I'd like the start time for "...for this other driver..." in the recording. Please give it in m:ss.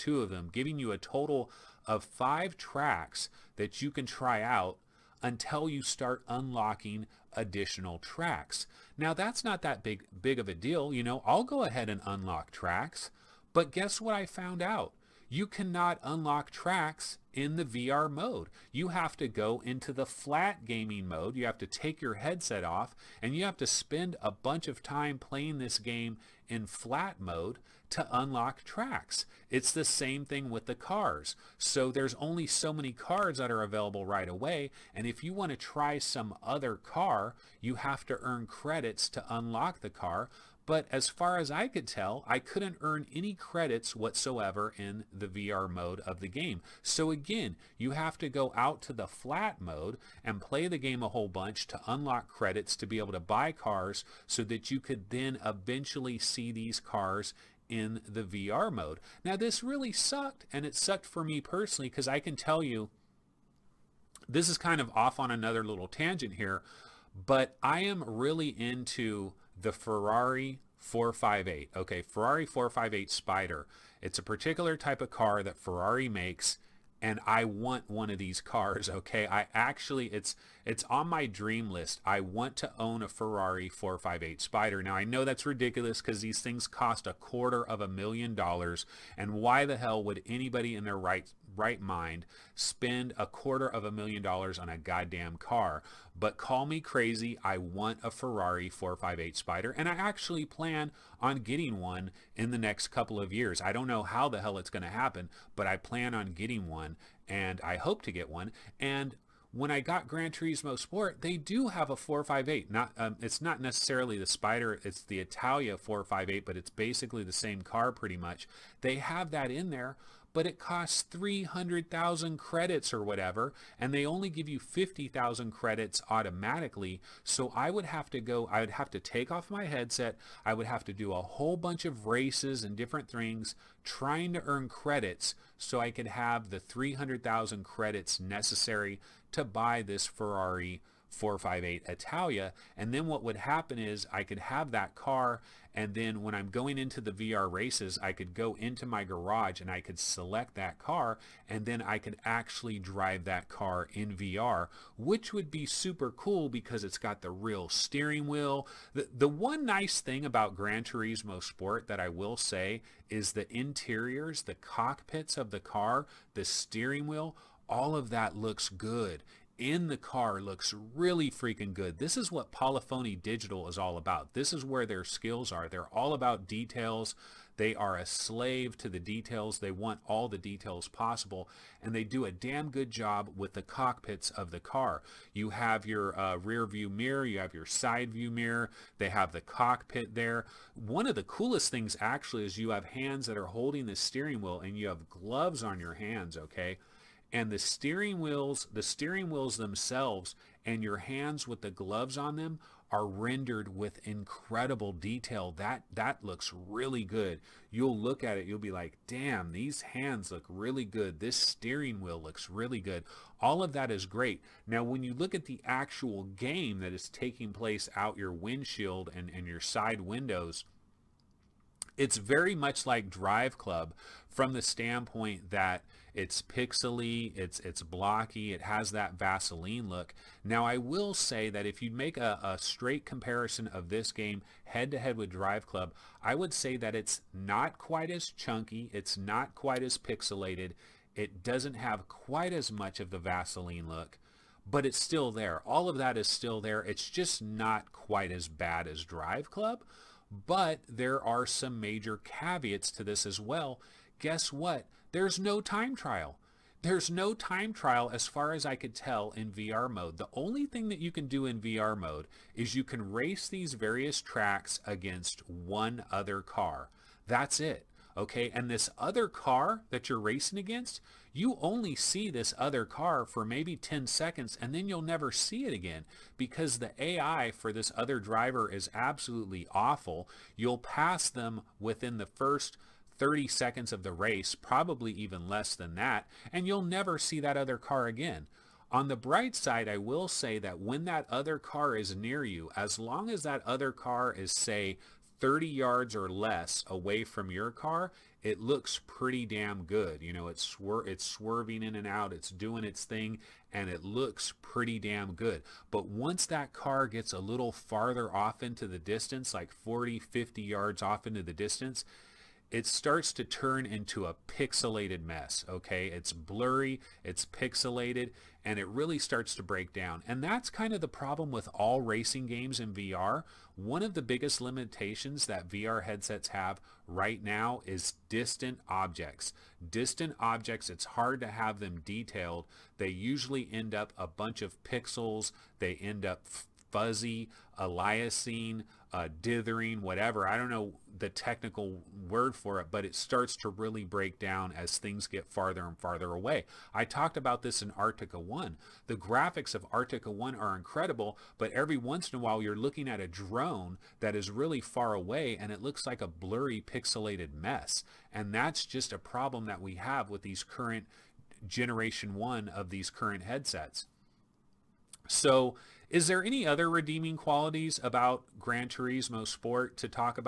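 4:37.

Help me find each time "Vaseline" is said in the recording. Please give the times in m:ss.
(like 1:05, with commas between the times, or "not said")
3:49, 4:03.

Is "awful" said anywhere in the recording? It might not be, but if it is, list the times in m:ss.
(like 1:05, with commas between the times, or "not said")
4:39.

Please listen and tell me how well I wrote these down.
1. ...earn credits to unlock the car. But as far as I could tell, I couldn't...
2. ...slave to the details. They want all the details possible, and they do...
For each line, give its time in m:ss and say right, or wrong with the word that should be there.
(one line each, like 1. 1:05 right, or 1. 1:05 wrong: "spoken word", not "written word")
1. 0:38 right
2. 2:58 right.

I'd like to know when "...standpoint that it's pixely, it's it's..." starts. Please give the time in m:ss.
3:44.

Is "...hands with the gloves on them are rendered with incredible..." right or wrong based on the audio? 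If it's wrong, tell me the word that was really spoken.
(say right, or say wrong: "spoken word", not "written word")
right.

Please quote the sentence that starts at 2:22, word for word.
And then what would happen is I could have that car.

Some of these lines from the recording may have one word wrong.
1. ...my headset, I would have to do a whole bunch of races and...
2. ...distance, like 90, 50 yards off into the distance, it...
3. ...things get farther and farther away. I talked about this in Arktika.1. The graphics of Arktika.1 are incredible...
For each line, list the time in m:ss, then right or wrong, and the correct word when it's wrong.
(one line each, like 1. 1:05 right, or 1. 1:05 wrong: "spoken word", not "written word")
1. 2:09 right
2. 5:08 wrong: "40", not "90"
3. 5:44 right.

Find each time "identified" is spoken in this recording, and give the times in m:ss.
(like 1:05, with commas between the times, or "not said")
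not said.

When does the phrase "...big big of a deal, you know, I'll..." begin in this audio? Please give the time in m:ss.
0:09.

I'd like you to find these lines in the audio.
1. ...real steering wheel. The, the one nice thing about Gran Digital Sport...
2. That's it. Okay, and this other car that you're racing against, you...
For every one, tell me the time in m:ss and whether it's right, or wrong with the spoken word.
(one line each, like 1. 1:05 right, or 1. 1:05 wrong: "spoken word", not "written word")
1. 2:37 wrong: "Turismo", not "Digital"
2. 4:27 right.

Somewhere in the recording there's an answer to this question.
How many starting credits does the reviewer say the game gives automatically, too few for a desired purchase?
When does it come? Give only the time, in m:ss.
2:04.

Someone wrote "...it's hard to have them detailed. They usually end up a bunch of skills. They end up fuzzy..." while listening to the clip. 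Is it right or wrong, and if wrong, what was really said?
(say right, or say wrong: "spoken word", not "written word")
wrong: "pixels", not "skills".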